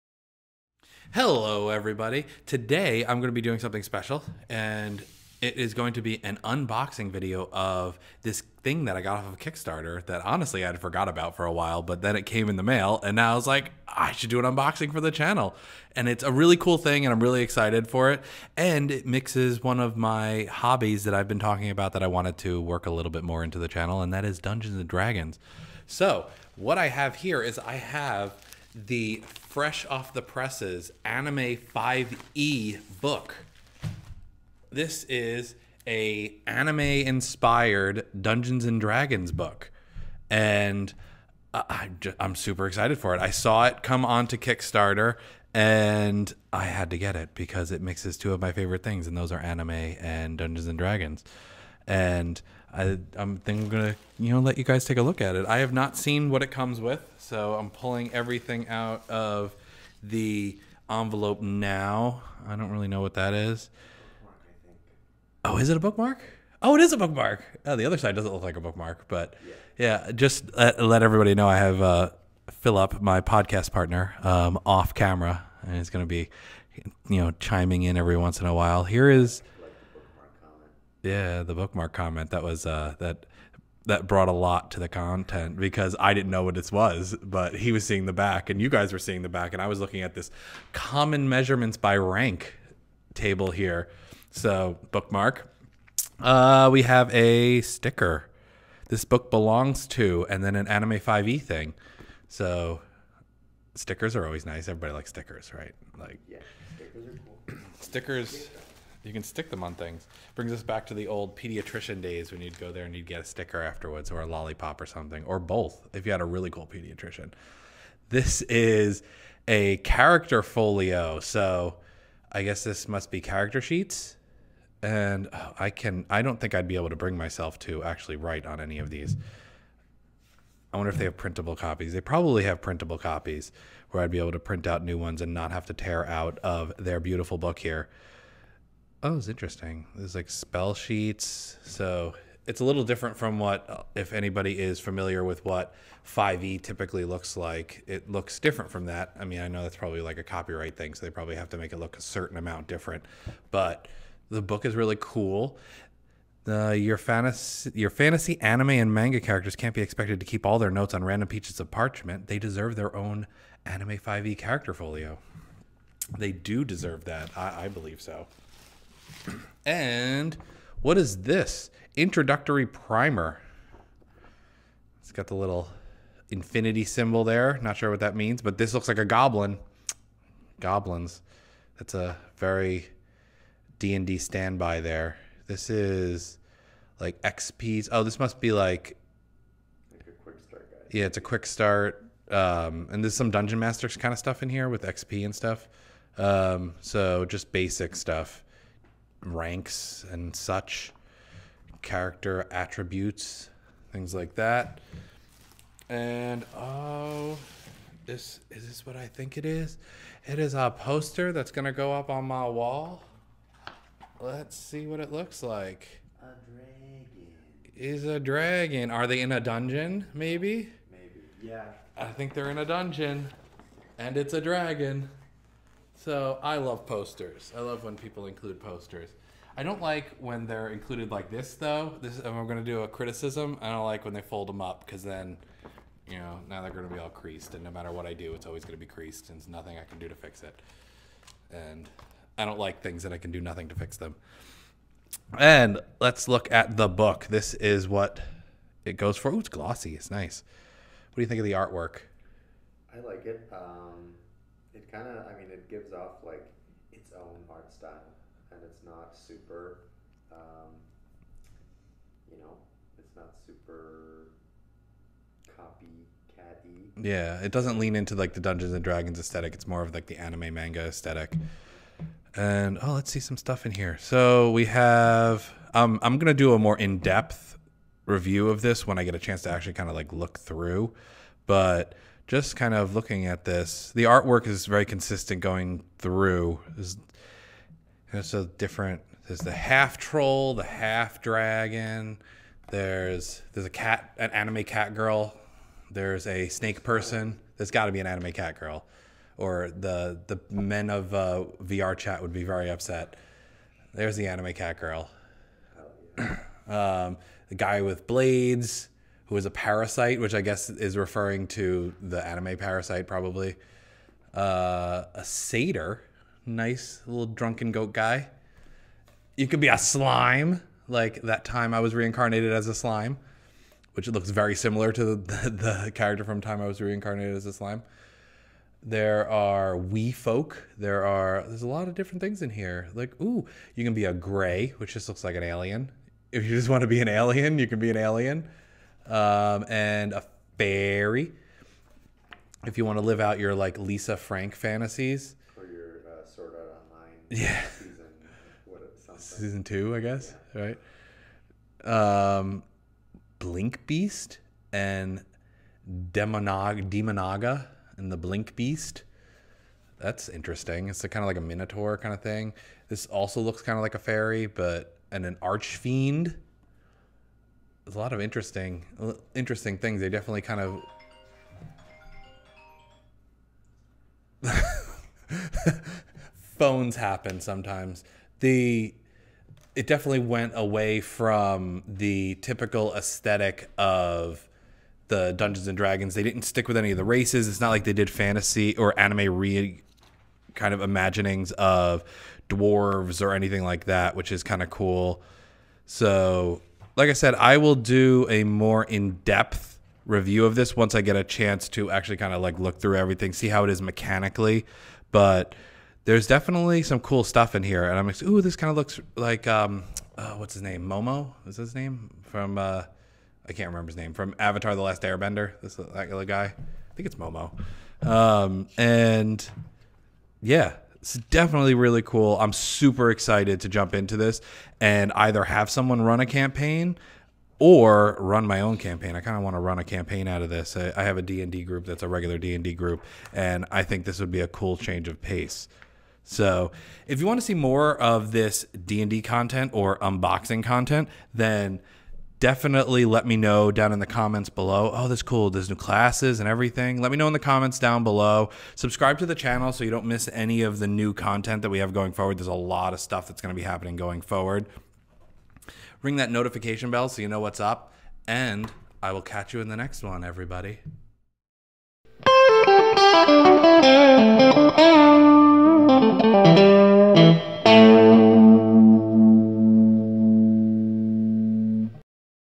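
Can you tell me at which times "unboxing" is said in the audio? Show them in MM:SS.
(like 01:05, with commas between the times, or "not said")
00:06, 00:14, 07:19.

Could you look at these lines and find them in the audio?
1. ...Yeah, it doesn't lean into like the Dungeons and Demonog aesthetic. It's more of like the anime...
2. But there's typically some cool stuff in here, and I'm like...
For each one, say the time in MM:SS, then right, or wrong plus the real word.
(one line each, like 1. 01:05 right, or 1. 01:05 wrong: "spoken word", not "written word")
1. 04:27 wrong: "Dragons", not "Demonog"
2. 06:45 wrong: "definitely", not "typically".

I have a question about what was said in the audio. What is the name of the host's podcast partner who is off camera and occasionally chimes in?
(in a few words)
Philip.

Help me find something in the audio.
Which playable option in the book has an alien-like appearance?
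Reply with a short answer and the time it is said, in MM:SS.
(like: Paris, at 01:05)
gray, at 05:34.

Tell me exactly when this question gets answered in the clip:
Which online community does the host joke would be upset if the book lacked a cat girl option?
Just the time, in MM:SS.
05:01.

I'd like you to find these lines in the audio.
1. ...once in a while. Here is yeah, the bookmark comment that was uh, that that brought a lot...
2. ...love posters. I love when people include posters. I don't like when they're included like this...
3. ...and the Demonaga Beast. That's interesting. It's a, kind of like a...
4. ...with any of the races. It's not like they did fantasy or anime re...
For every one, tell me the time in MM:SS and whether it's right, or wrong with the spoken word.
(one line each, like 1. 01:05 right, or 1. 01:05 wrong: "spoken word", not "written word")
1. 01:18 right
2. 03:46 right
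3. 05:57 wrong: "Blink", not "Demonaga"
4. 06:26 right.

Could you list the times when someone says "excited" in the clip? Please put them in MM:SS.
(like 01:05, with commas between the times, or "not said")
00:17, 00:42, 07:03.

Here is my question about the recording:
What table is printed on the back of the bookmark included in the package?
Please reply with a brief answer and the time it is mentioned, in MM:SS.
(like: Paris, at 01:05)
common measurements by rank, at 01:30.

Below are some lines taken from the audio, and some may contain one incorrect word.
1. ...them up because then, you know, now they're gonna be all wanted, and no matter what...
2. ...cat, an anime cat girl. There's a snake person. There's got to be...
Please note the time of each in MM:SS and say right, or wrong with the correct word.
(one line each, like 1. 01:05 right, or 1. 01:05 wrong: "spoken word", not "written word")
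1. 03:54 wrong: "creased", not "wanted"
2. 04:53 right.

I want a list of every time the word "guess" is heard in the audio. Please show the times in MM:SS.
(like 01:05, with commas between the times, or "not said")
02:02, 05:10, 05:49.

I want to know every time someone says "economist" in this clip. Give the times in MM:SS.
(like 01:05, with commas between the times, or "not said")
not said.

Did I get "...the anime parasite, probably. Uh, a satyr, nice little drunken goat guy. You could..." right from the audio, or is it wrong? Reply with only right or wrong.
right.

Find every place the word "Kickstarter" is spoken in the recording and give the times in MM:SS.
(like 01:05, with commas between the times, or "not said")
00:09, 00:44.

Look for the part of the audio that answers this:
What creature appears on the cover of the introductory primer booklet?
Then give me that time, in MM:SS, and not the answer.
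02:59.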